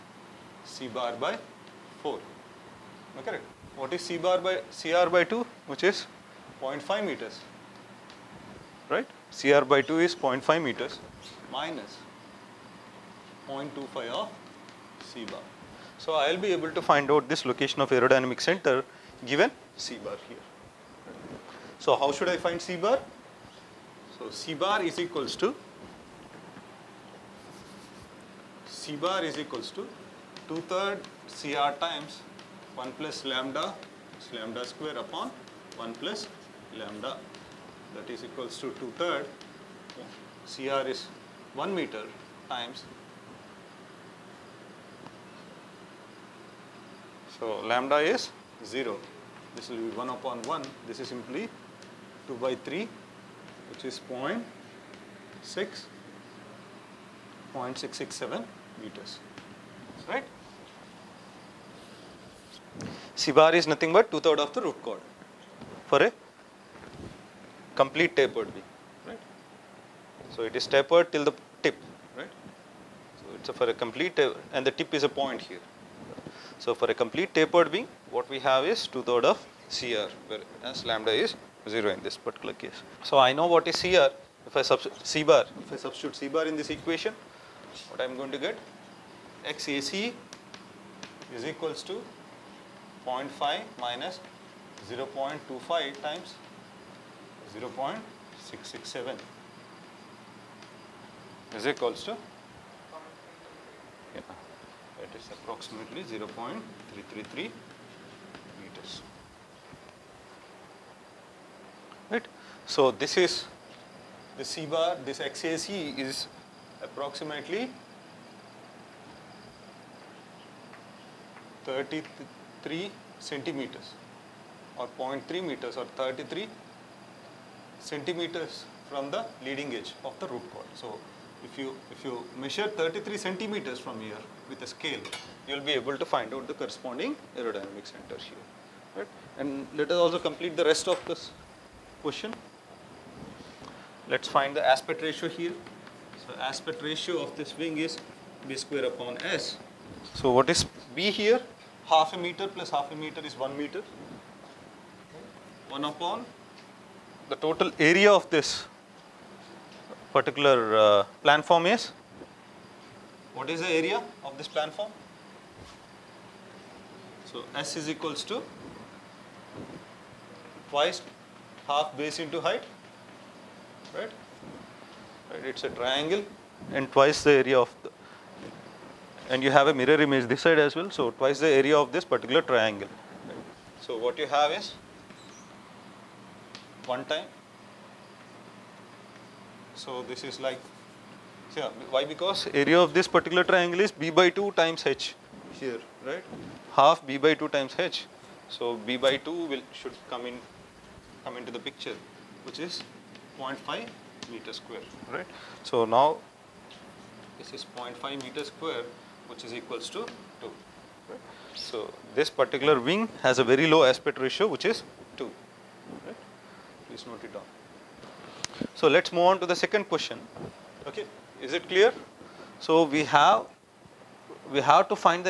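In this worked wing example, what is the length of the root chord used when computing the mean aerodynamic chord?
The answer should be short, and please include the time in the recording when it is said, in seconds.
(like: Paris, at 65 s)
1 meter, at 40 s.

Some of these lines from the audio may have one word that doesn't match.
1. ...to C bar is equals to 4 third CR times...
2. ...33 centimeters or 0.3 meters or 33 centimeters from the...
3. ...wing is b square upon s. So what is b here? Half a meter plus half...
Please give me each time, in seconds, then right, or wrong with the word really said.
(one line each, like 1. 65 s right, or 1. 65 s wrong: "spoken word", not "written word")
1. 25 s wrong: "2", not "4"
2. 121 s right
3. 147 s right.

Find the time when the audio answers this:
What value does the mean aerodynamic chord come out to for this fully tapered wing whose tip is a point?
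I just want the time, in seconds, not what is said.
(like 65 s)
57 s.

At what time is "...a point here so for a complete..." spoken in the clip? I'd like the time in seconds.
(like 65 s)
75 s.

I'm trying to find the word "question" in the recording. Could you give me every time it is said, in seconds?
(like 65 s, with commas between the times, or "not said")
142 s, 219 s.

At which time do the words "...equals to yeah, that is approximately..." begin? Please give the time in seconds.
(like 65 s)
101 s.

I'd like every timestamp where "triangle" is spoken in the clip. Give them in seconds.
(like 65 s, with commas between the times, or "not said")
175 s, 182 s, 193 s.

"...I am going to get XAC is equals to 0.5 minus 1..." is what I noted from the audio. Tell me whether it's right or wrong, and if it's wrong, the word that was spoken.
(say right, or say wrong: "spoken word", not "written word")
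wrong: "0", not "1".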